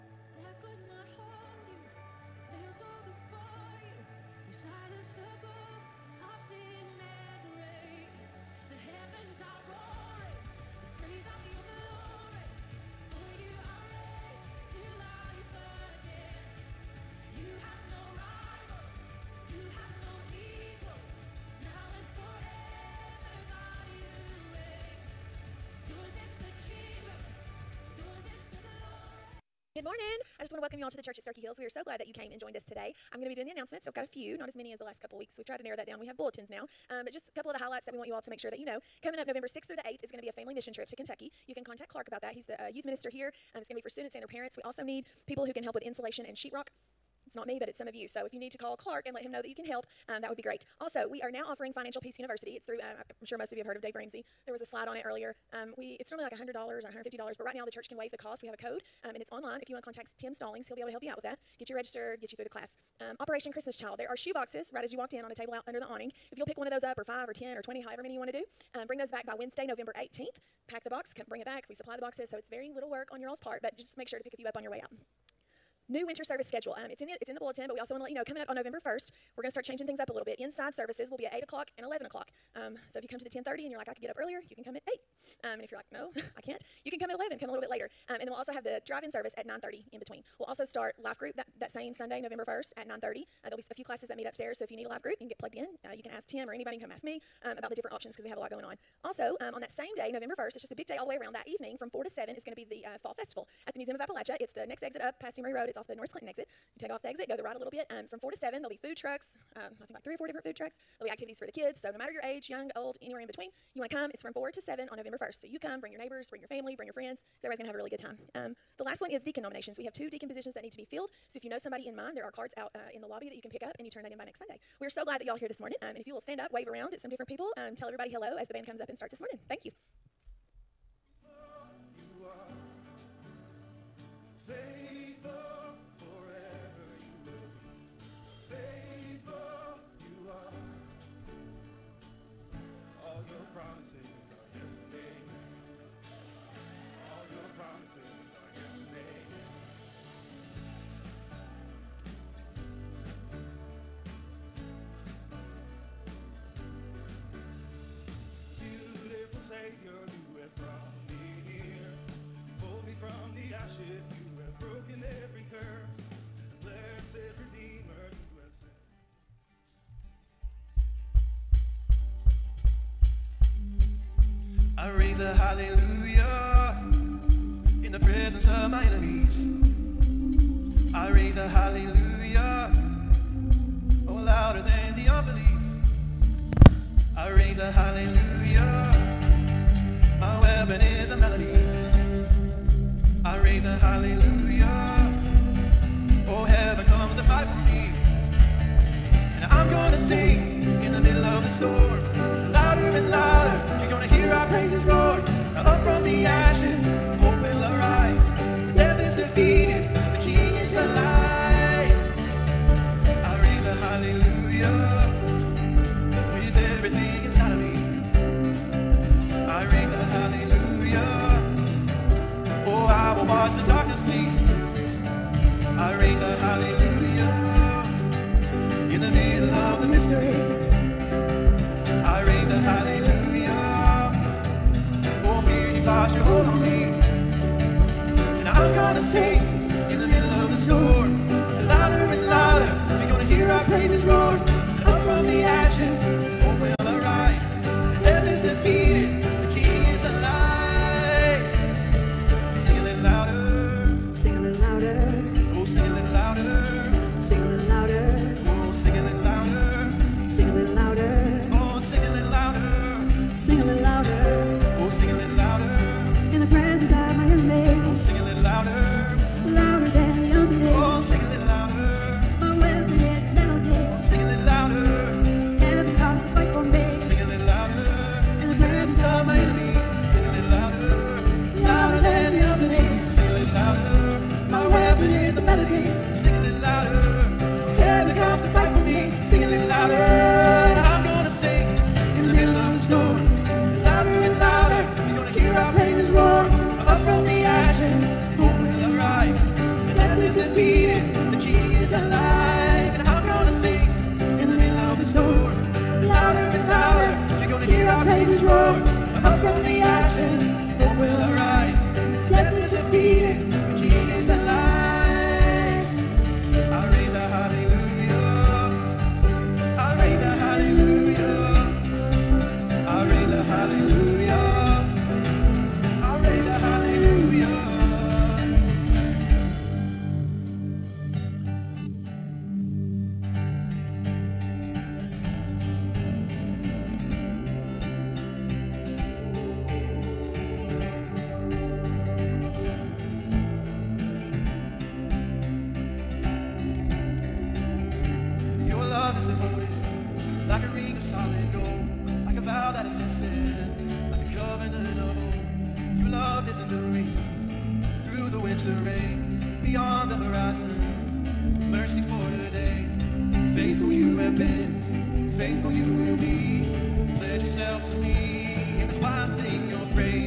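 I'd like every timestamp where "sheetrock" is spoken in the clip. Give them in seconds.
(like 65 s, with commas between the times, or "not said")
46 s.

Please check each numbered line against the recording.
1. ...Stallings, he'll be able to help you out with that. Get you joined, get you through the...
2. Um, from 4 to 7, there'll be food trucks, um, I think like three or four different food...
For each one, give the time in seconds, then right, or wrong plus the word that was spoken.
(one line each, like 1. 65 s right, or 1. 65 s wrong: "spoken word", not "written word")
1. 60 s wrong: "registered", not "joined"
2. 107 s right.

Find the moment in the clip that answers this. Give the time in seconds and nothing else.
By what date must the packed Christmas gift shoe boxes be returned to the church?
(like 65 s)
69 s.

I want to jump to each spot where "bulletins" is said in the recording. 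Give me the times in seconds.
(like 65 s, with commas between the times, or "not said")
36 s, 77 s.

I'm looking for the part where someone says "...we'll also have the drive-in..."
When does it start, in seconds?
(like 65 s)
88 s.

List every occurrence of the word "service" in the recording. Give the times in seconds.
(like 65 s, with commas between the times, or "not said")
76 s, 80 s, 89 s.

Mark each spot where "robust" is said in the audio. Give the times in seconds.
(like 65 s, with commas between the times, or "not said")
not said.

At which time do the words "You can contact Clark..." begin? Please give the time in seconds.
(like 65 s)
41 s.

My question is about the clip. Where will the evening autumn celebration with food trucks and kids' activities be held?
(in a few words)
Museum of Appalachia.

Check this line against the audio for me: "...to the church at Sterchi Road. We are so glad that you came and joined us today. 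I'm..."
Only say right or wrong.
wrong.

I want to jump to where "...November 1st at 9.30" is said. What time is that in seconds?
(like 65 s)
92 s.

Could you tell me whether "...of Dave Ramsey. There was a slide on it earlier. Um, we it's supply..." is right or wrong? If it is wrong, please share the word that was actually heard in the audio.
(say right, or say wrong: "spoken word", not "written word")
wrong: "normally", not "supply".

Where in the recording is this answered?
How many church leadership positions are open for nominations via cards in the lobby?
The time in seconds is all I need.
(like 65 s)
119 s.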